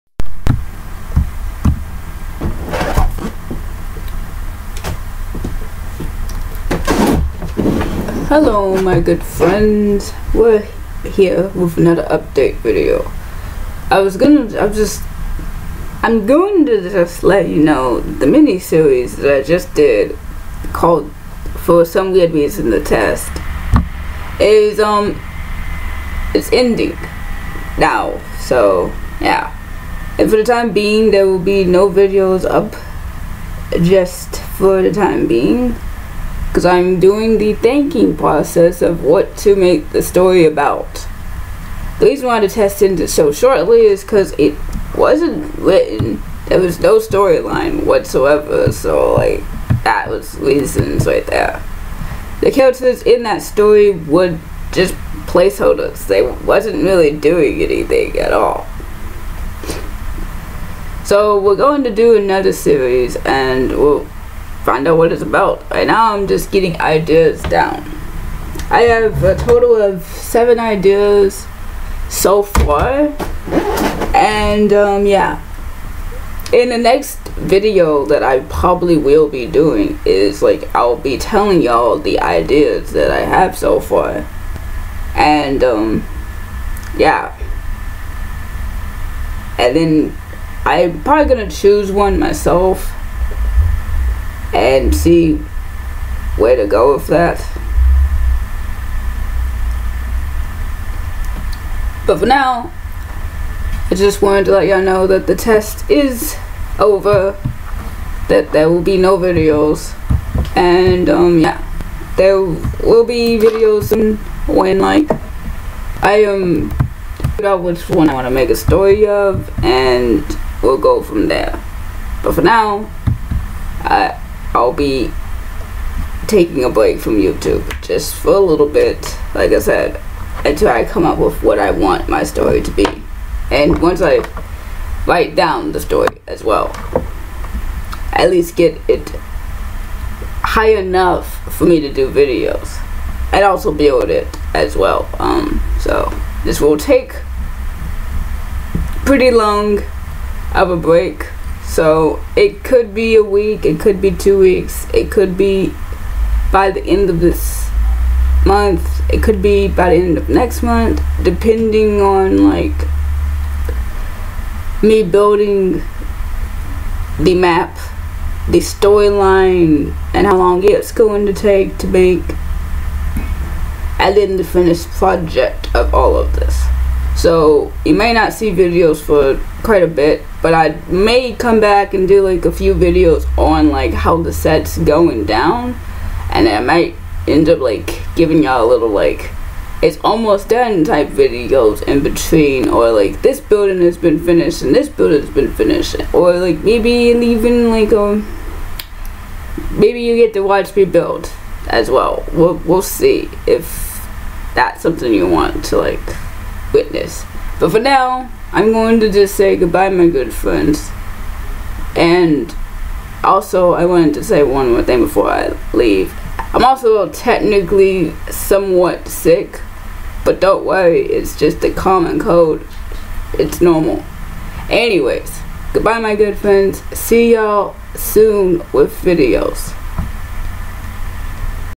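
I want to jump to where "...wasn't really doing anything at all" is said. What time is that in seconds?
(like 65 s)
56 s.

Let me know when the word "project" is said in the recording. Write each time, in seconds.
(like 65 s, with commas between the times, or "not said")
174 s.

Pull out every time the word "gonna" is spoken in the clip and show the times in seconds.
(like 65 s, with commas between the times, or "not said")
14 s, 91 s.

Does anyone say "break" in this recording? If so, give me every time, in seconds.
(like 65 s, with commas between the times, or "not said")
126 s, 150 s.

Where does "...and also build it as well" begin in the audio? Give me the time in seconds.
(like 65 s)
143 s.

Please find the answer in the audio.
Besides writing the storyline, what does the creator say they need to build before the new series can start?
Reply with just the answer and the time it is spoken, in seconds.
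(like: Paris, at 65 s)
the map, at 167 s.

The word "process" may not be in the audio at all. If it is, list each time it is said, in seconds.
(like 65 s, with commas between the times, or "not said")
38 s.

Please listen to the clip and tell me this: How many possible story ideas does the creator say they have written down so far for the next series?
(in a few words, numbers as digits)
7.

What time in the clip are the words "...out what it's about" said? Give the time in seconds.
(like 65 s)
64 s.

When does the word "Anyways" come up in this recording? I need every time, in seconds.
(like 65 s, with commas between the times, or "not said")
224 s.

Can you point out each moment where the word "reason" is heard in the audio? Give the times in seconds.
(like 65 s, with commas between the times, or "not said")
22 s, 42 s, 50 s.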